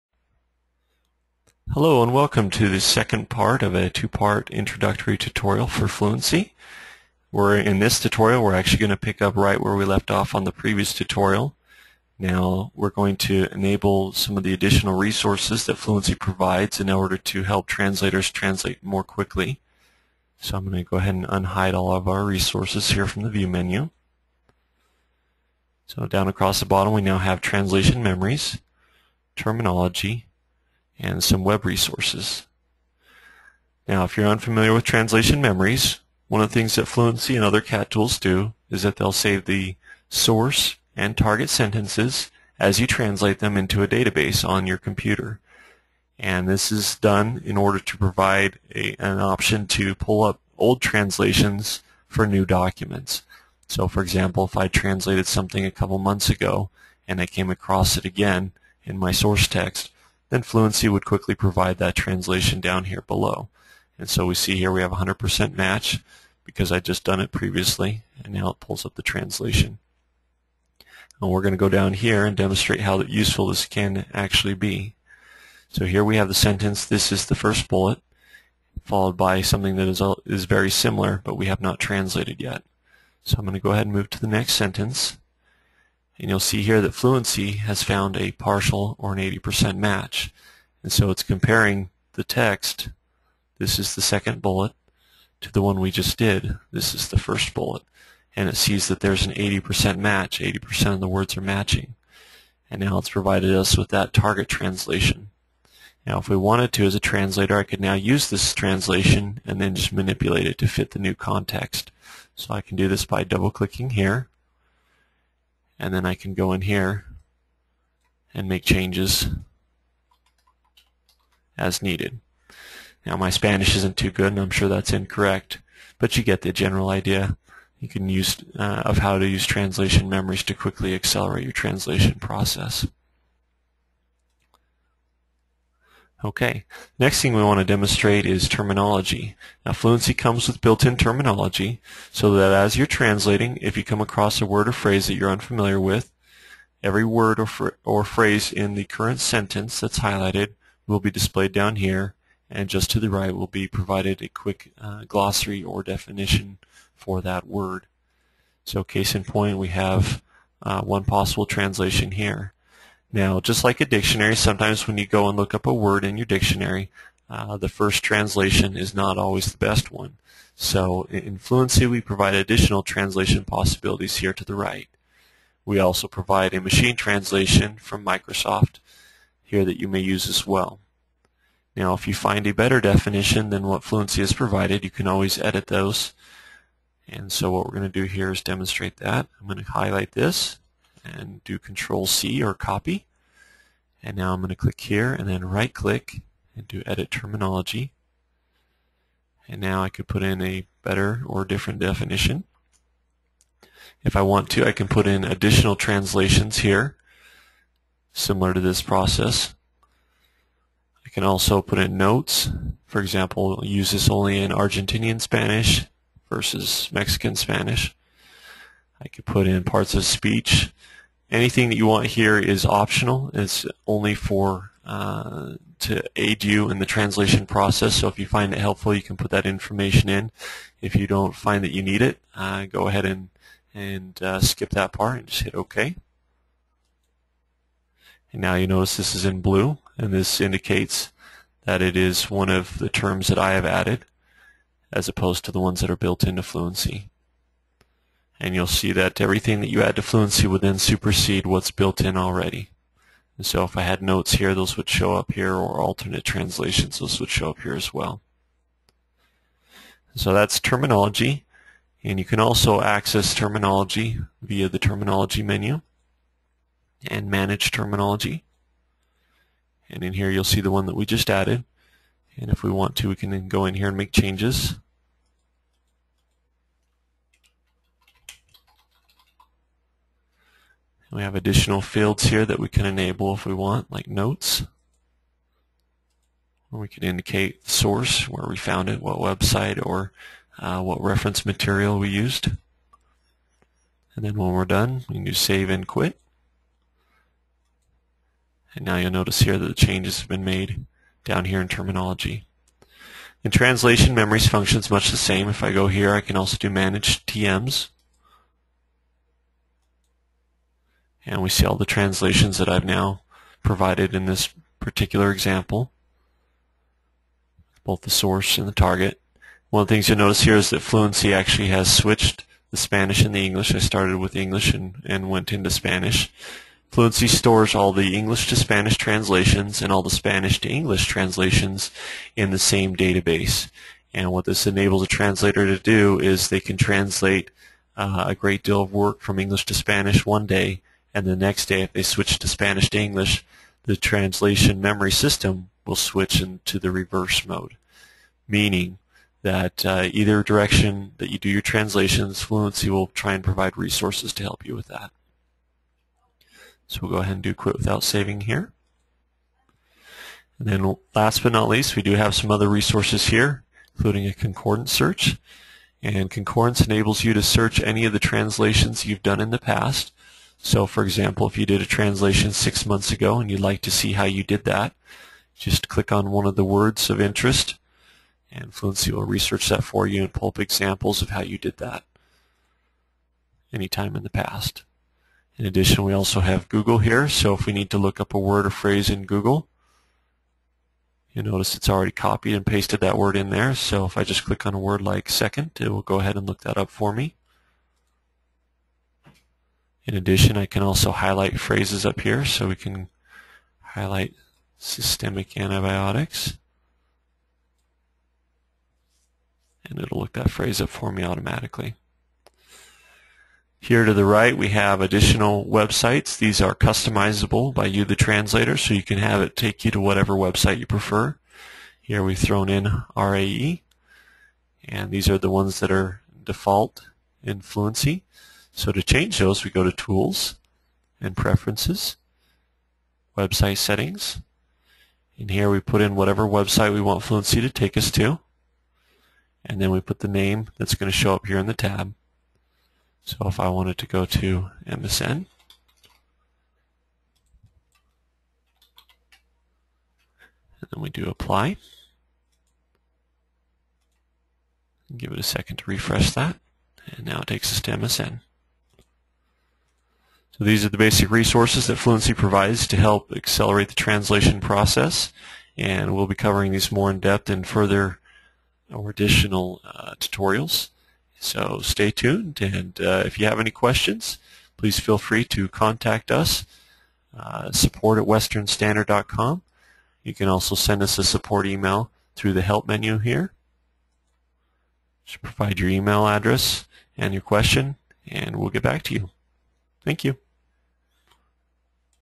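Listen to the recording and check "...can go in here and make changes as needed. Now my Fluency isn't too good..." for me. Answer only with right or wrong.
wrong.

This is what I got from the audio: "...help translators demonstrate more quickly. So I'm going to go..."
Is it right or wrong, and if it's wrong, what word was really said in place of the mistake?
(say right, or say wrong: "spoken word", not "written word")
wrong: "translate", not "demonstrate".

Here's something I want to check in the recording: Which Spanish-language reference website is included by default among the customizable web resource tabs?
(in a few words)
RAE.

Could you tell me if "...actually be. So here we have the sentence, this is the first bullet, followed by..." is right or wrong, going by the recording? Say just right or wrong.
right.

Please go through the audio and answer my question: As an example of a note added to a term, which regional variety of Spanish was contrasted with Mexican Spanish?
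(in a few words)
Argentinian Spanish.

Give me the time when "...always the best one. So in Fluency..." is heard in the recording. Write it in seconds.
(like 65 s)
169 s.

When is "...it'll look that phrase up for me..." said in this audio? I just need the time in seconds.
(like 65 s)
409 s.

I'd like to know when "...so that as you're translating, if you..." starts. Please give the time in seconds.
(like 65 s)
142 s.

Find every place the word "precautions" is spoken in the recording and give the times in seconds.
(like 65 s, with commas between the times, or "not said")
not said.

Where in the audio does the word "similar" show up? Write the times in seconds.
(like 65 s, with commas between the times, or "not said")
80 s, 208 s.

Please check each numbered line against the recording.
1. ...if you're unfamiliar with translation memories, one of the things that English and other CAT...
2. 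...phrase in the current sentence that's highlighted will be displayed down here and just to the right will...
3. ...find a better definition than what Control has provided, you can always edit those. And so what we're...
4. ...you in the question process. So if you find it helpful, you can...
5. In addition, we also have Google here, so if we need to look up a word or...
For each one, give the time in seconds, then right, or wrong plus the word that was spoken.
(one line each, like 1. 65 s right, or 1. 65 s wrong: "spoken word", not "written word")
1. 34 s wrong: "Fluency", not "English"
2. 148 s right
3. 182 s wrong: "Fluency", not "Control"
4. 226 s wrong: "translation", not "question"
5. 385 s right.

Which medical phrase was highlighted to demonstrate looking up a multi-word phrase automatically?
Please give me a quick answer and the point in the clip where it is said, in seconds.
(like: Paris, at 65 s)
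Systemic antibiotics, at 404 s.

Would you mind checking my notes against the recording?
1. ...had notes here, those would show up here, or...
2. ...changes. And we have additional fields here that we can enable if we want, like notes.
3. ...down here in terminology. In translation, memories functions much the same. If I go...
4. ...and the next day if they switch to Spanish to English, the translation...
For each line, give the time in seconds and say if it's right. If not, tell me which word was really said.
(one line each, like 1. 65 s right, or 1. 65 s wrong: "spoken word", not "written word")
1. 253 s right
2. 274 s right
3. 301 s right
4. 341 s right.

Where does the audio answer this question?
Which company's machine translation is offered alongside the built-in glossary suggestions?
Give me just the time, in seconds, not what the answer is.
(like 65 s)
178 s.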